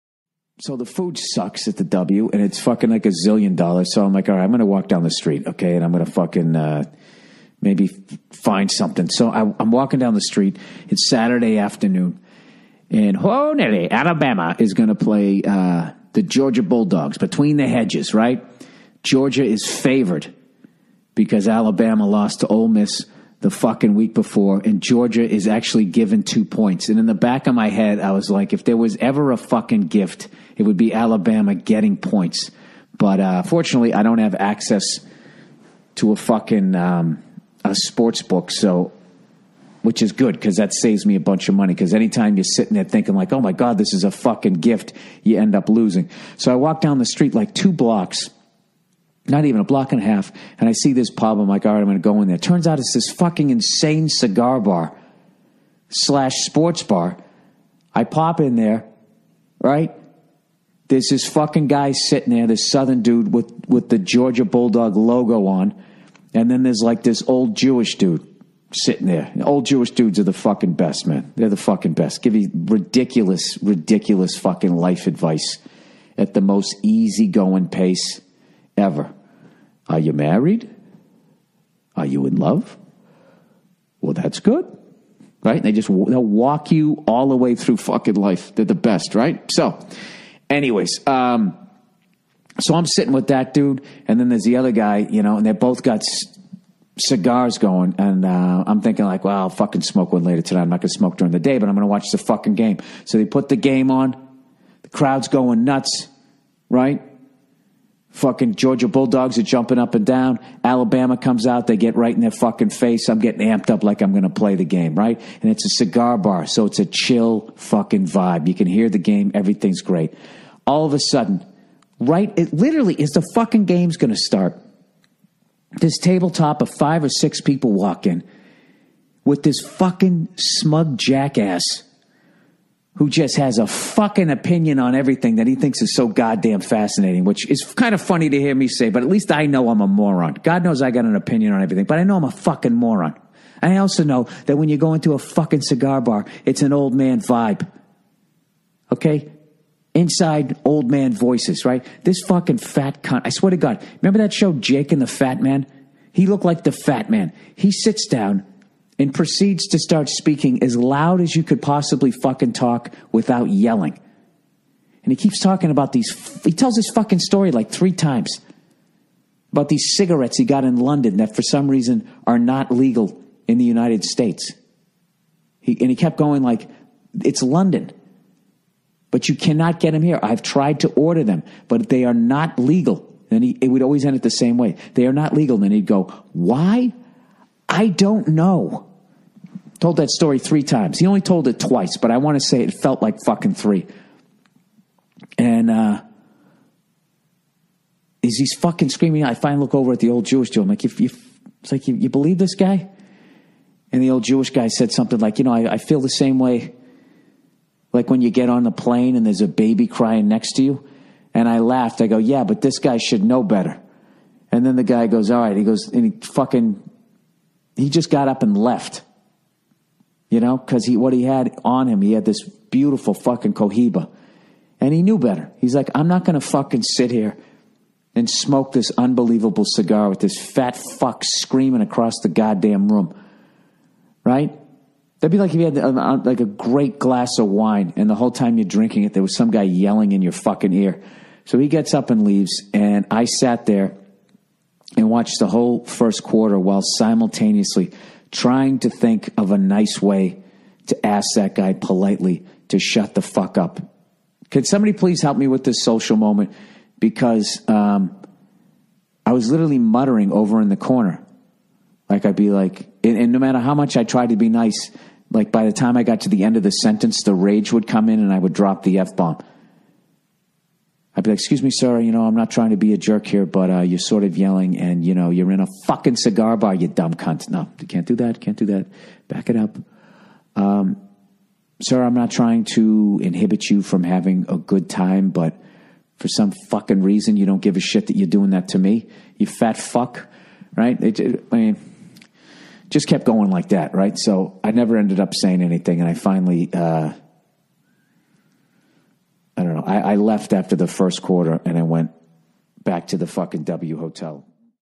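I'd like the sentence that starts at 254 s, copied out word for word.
Could somebody please help me with this social moment?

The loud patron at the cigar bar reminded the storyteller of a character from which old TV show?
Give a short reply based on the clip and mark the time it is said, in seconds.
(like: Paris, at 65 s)
Jake and the Fat Man, at 154 s.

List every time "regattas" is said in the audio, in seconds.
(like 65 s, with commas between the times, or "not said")
not said.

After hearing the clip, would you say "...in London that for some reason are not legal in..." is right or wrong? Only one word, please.
right.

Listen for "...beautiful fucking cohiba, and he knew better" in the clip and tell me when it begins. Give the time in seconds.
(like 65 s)
222 s.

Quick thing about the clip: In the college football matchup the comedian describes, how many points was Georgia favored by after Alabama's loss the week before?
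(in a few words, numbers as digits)
2.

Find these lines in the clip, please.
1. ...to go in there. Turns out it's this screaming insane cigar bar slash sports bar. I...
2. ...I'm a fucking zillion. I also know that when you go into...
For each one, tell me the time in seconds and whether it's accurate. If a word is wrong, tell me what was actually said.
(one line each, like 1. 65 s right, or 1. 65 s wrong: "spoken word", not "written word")
1. 51 s wrong: "fucking", not "screaming"
2. 142 s wrong: "moron", not "zillion".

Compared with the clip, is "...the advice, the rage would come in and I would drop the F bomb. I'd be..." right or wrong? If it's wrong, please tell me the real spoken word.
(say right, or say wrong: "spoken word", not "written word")
wrong: "sentence", not "advice".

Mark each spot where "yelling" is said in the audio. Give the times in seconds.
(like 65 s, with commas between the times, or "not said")
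163 s, 239 s, 274 s.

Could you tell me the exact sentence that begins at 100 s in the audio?
I'm not gonna smoke during the day, but I'm gonna watch the fucking game.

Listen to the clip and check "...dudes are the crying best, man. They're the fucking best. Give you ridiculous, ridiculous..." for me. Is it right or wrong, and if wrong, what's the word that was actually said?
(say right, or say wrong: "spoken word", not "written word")
wrong: "fucking", not "crying".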